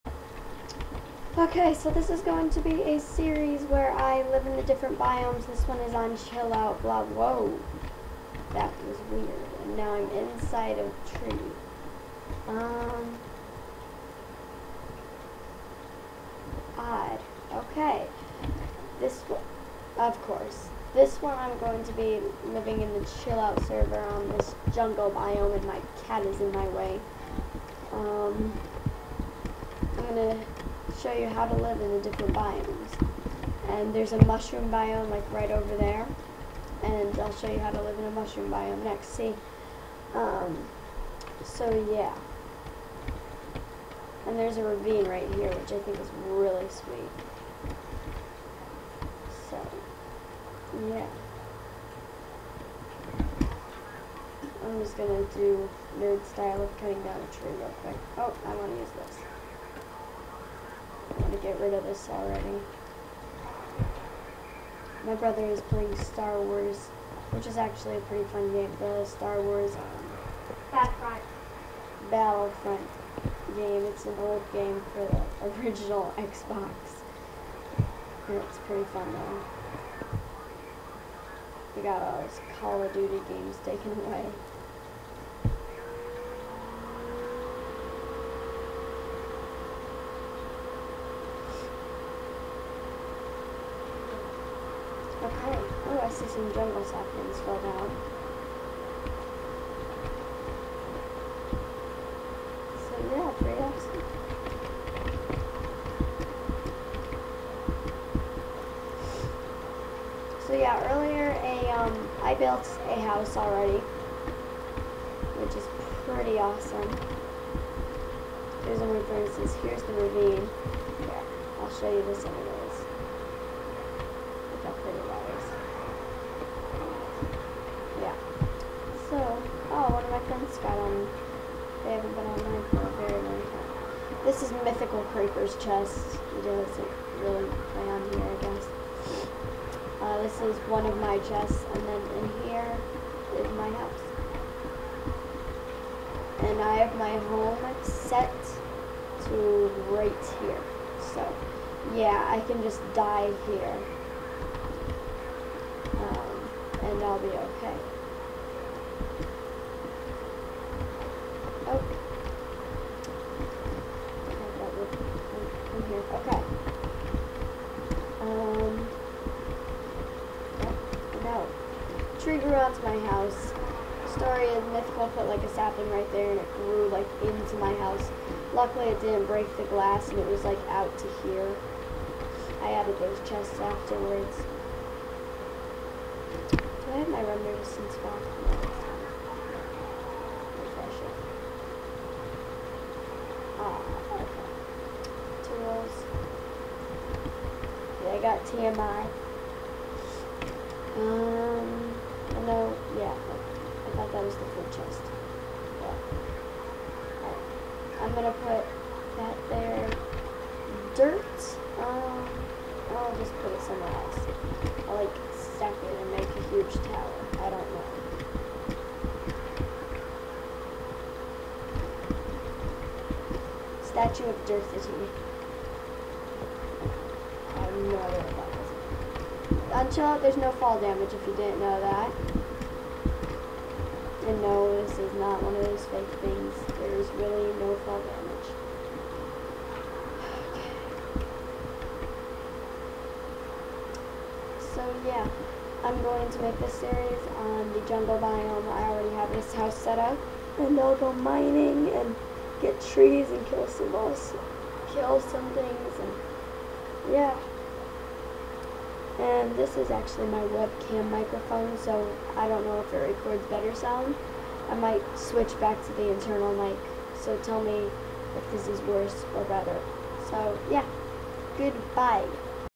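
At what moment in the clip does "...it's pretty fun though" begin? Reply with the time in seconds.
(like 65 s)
78 s.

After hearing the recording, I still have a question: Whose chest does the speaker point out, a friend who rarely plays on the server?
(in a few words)
Mythical Creeper.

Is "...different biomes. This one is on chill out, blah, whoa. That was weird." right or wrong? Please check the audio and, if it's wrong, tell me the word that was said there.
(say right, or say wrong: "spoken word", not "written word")
right.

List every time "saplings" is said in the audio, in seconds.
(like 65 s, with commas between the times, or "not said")
96 s, 175 s.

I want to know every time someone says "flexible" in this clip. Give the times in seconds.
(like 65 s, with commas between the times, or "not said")
not said.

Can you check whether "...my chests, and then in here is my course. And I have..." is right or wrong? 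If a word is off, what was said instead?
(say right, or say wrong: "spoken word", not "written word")
wrong: "house", not "course".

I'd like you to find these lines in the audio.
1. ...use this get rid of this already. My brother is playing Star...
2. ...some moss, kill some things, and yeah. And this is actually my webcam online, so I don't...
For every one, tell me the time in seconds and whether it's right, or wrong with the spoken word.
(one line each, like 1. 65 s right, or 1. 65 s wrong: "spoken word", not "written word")
1. 58 s right
2. 253 s wrong: "microphone", not "online".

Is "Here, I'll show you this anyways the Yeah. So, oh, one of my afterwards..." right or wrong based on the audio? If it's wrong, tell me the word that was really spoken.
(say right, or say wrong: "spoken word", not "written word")
wrong: "friends", not "afterwards".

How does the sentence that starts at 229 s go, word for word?
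Until there's no fall damage if you didn't know that.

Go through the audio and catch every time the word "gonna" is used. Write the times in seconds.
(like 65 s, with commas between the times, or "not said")
30 s, 54 s, 208 s.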